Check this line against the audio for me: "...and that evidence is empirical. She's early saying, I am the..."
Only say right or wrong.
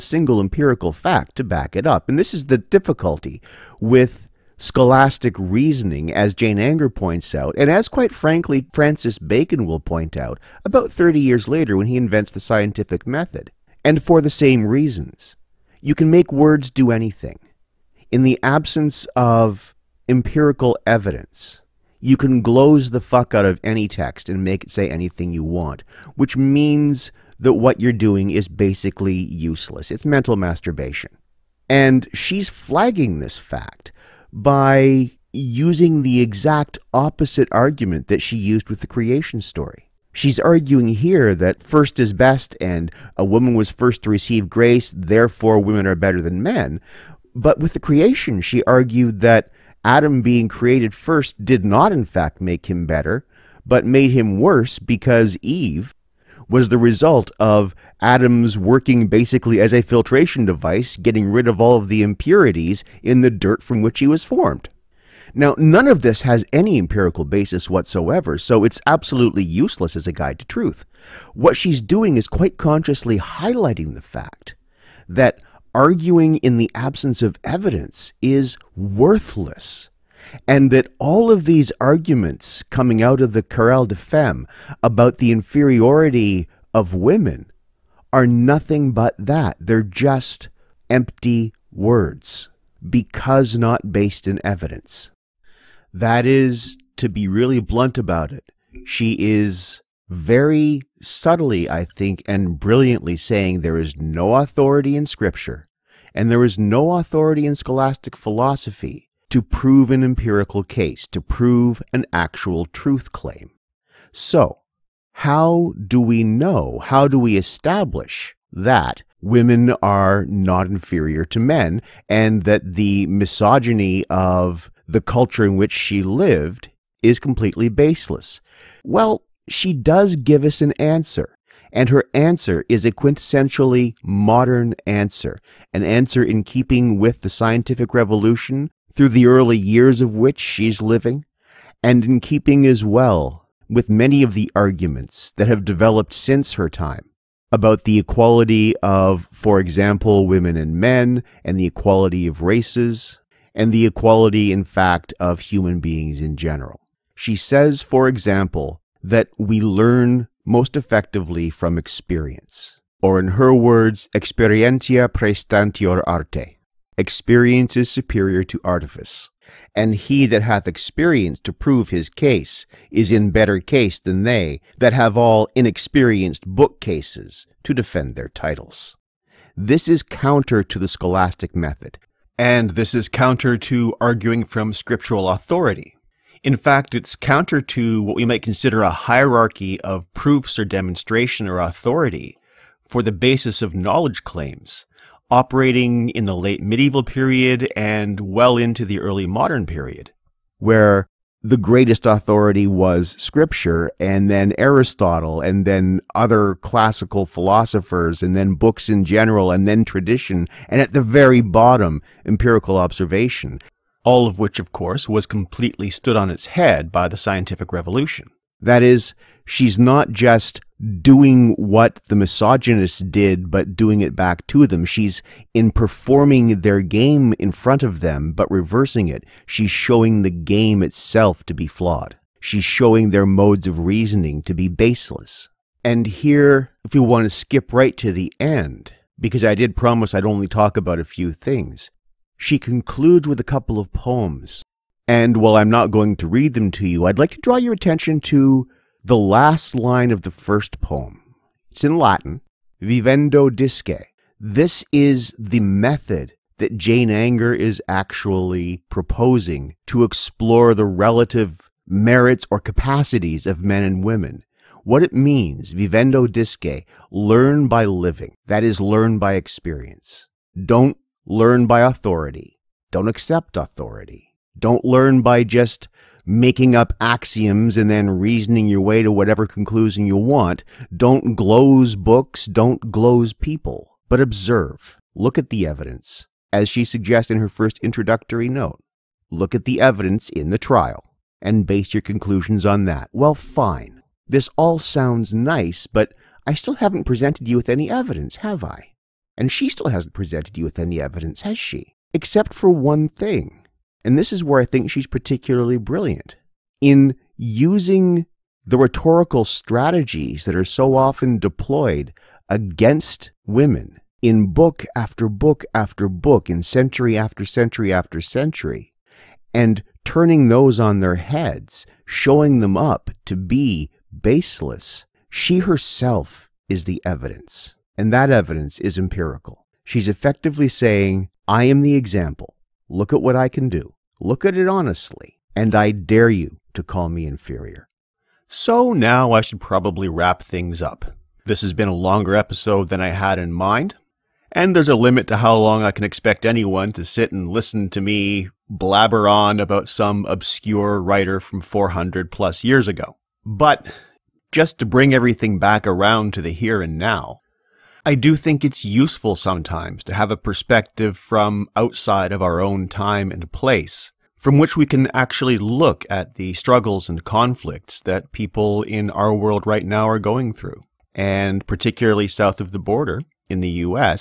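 wrong.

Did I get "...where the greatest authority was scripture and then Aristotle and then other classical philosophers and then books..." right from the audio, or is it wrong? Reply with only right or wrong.
right.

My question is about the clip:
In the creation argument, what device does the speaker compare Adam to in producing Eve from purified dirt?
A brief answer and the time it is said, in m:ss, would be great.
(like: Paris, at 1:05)
filtration device, at 0:59.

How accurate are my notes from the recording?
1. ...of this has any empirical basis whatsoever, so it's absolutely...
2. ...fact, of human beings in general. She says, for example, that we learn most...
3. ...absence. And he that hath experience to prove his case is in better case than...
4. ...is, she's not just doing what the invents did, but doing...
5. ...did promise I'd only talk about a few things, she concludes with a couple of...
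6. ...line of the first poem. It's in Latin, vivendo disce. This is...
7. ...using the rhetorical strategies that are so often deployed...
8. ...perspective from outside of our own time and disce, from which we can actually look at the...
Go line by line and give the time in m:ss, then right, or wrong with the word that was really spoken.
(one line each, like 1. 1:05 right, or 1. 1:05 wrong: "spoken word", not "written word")
1. 1:05 right
2. 2:34 right
3. 2:48 wrong: "artifice", not "absence"
4. 3:38 wrong: "misogynists", not "invents"
5. 3:59 right
6. 4:09 right
7. 5:07 right
8. 6:00 wrong: "place", not "disce".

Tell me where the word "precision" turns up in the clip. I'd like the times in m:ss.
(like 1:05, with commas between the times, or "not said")
not said.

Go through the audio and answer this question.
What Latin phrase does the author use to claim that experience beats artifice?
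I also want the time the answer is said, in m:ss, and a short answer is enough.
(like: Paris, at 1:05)
experientia prestantior arte, at 2:44.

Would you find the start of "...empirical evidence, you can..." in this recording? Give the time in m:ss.
0:20.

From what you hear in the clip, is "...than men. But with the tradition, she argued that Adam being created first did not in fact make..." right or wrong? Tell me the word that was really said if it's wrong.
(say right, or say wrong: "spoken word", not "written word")
wrong: "creation", not "tradition".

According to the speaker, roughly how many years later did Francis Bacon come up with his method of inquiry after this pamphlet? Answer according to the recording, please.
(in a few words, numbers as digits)
30.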